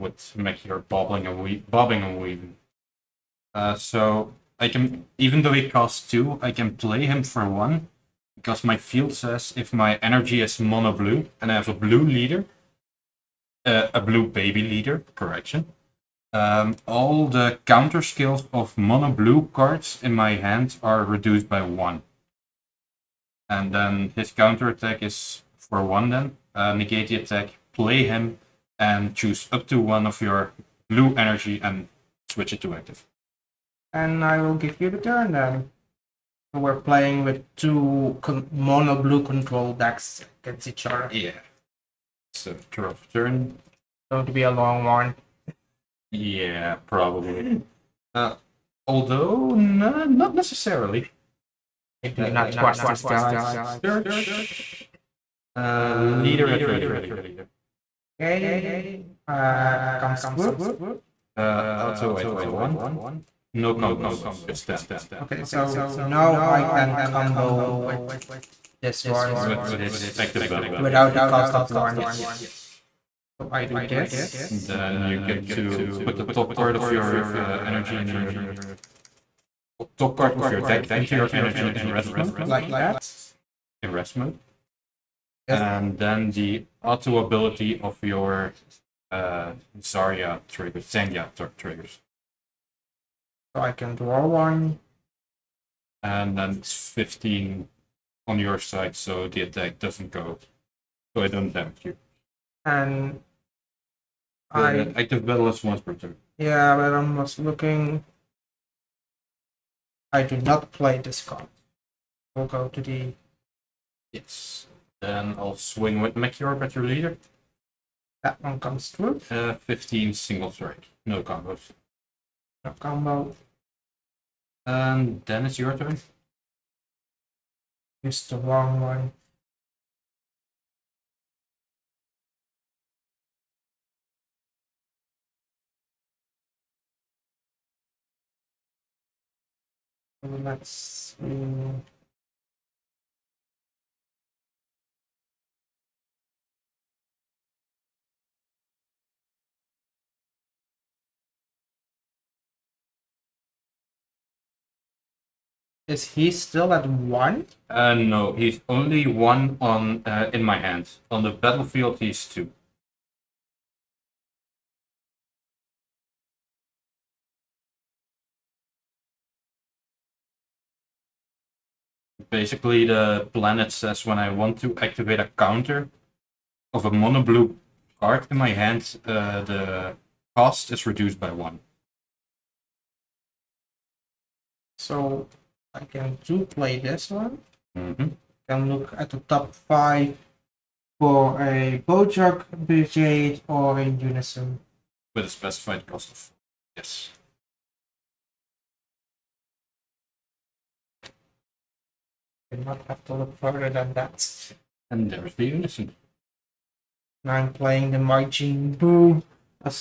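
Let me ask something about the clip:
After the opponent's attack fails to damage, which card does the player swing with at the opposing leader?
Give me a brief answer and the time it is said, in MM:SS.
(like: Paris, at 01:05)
Meteor, at 01:56.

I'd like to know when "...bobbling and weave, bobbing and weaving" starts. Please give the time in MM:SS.
00:00.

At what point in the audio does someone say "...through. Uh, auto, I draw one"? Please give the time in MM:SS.
01:00.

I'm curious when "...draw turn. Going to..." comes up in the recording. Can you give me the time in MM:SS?
00:42.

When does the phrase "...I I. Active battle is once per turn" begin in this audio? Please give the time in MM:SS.
01:44.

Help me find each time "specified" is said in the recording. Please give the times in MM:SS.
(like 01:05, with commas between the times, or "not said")
03:15.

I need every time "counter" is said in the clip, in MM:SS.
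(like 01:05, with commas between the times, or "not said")
00:17, 00:24, 02:55.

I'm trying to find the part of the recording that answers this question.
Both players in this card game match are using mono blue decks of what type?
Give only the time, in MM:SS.
00:38.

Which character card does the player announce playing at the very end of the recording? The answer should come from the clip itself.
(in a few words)
Majin Buu.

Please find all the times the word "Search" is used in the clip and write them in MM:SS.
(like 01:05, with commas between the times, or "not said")
00:53.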